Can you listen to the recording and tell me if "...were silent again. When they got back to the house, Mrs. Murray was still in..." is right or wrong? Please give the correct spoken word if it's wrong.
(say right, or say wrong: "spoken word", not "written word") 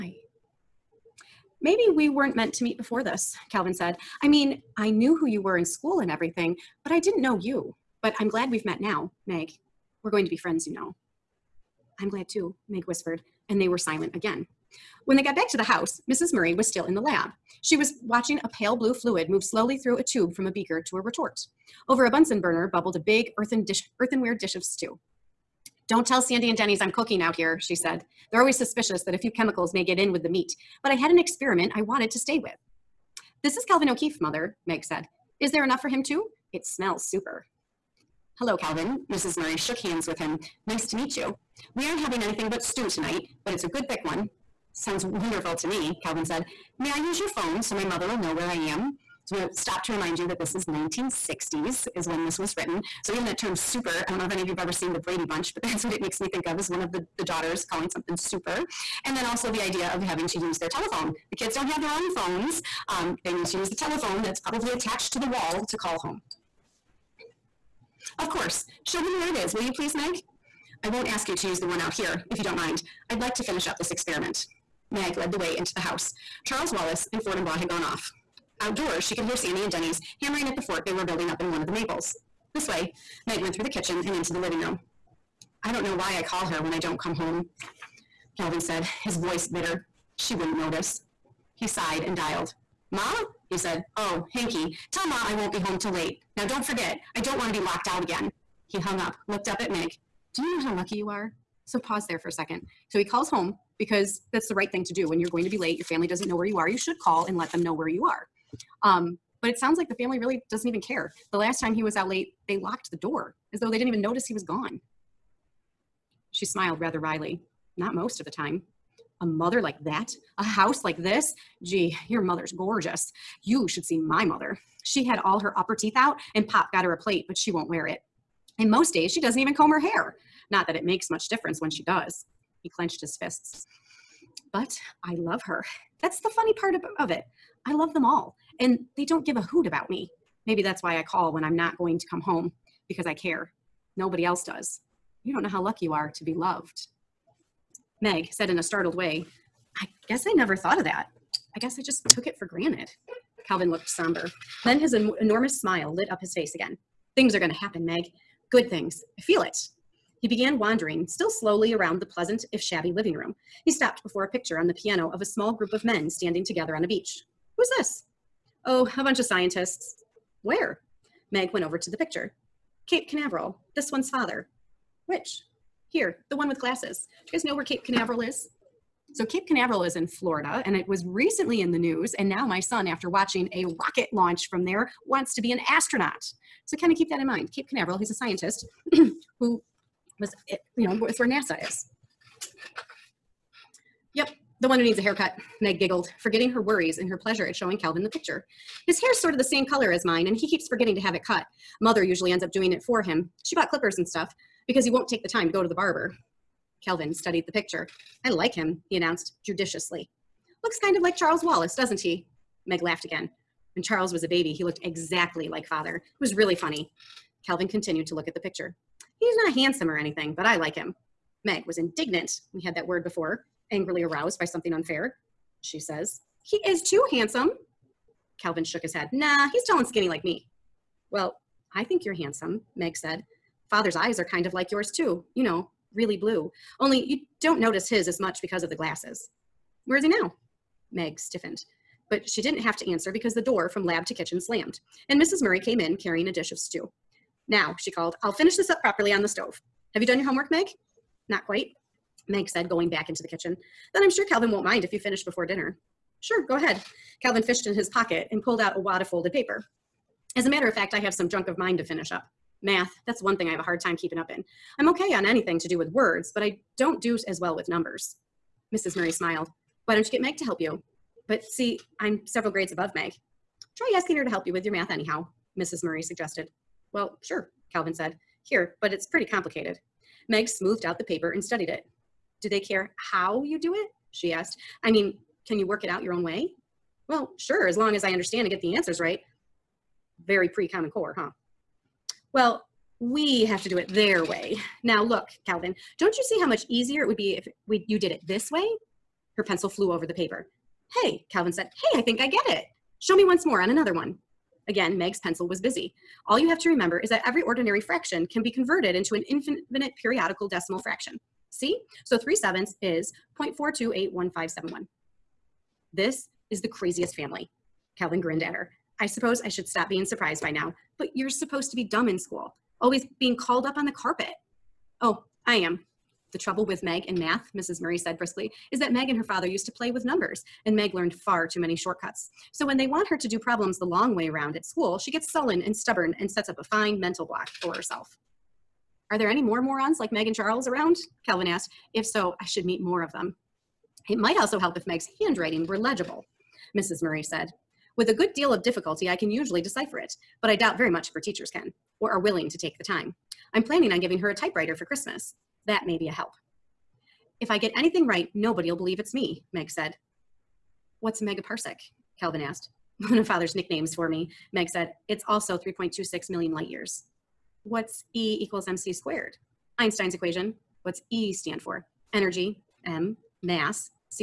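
right.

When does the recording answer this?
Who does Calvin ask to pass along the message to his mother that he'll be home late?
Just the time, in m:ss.
1:34.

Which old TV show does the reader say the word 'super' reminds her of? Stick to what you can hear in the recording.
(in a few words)
The Brady Bunch.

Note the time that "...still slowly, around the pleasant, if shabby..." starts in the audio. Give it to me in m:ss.
2:41.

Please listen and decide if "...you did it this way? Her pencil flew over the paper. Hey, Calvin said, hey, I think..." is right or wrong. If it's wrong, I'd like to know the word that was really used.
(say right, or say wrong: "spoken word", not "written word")
right.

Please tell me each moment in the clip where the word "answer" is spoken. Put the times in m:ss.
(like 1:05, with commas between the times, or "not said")
4:02, 4:48.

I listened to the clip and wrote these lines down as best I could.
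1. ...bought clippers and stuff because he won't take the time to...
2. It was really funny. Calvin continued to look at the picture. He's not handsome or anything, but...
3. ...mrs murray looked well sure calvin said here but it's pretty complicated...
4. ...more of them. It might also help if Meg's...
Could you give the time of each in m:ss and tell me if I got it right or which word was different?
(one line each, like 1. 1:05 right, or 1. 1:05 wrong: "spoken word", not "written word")
1. 3:23 right
2. 3:35 right
3. 4:35 wrong: "suggested", not "looked"
4. 5:42 right.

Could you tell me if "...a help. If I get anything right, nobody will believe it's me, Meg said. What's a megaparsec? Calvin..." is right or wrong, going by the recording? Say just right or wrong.
right.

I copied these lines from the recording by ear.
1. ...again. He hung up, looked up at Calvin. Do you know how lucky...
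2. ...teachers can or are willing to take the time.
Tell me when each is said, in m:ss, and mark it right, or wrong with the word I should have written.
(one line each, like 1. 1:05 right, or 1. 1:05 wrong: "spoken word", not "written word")
1. 1:38 wrong: "Meg", not "Calvin"
2. 5:51 right.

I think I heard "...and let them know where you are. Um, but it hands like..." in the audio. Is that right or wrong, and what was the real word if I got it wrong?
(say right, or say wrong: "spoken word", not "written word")
wrong: "sounds", not "hands".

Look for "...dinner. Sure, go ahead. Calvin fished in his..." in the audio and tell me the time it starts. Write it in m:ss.
4:15.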